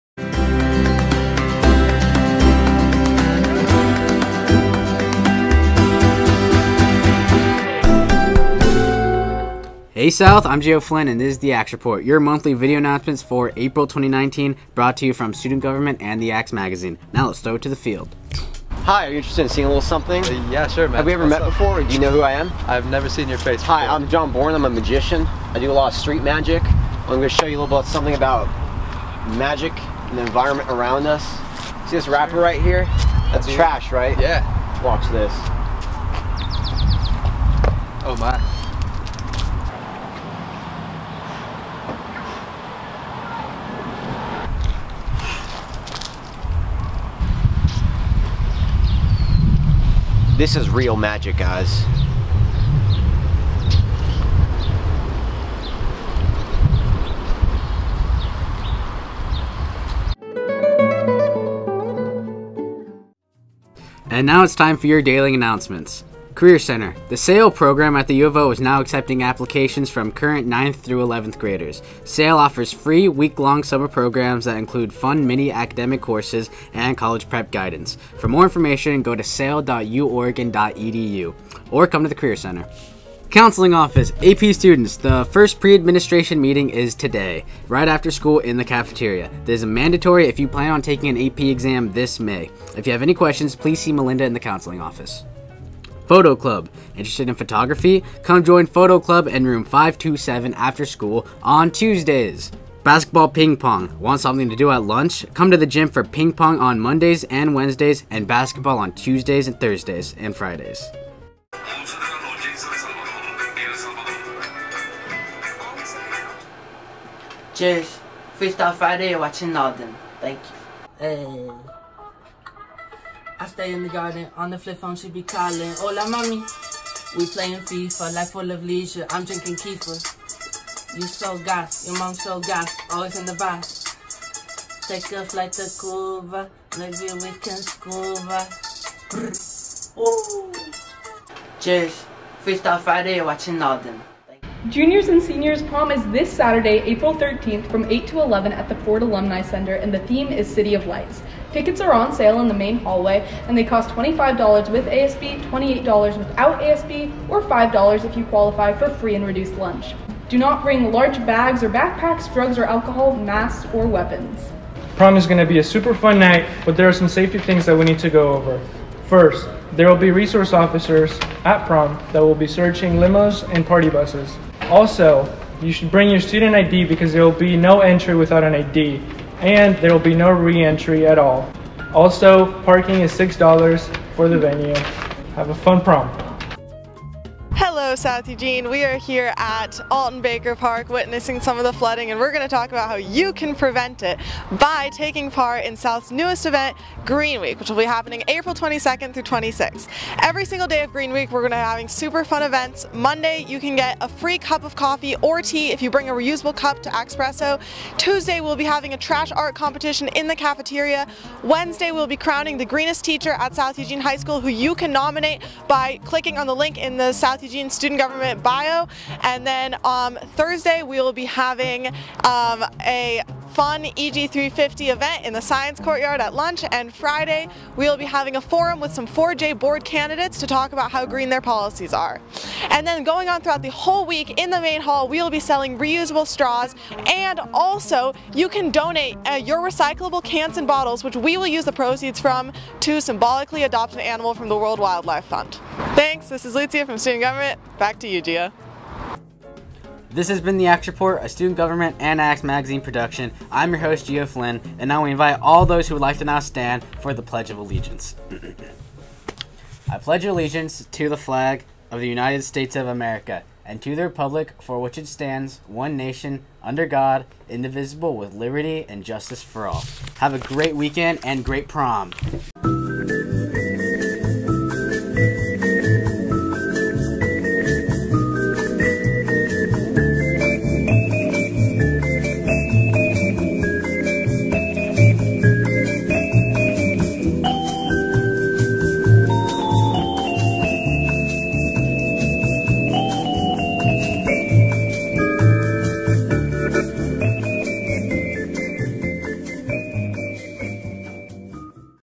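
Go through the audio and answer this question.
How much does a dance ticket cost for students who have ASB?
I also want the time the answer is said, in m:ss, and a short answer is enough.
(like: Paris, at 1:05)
$25, at 2:33.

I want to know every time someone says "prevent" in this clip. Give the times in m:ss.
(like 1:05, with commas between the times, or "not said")
3:13.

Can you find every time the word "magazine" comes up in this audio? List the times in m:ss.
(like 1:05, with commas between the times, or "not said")
0:16, 4:12.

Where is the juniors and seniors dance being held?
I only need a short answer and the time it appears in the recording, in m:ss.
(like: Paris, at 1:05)
Ford Alumni Center, at 2:28.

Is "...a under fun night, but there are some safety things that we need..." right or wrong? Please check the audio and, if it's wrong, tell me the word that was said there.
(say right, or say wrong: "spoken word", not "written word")
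wrong: "super", not "under".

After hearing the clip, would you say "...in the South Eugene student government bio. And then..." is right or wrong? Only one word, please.
right.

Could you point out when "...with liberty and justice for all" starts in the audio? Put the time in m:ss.
4:28.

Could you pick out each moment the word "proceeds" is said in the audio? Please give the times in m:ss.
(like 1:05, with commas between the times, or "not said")
4:01.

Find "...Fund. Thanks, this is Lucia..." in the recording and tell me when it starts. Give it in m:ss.
4:05.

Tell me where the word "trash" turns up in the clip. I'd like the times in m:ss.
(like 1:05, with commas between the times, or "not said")
0:33, 3:28.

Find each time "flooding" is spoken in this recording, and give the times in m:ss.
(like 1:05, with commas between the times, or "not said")
3:11.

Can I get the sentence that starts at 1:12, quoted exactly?
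SAIL offers free, week-long summer programs that include fun mini academic courses and college prep guidance.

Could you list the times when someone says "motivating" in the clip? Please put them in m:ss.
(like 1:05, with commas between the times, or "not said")
not said.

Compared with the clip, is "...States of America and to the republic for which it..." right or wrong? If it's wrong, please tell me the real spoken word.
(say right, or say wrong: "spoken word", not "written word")
right.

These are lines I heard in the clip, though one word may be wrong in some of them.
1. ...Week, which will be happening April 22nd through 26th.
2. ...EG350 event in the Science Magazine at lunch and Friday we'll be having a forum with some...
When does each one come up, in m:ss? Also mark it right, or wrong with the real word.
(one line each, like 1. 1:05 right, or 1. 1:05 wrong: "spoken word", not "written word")
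1. 3:17 right
2. 3:43 wrong: "Courtyard", not "Magazine".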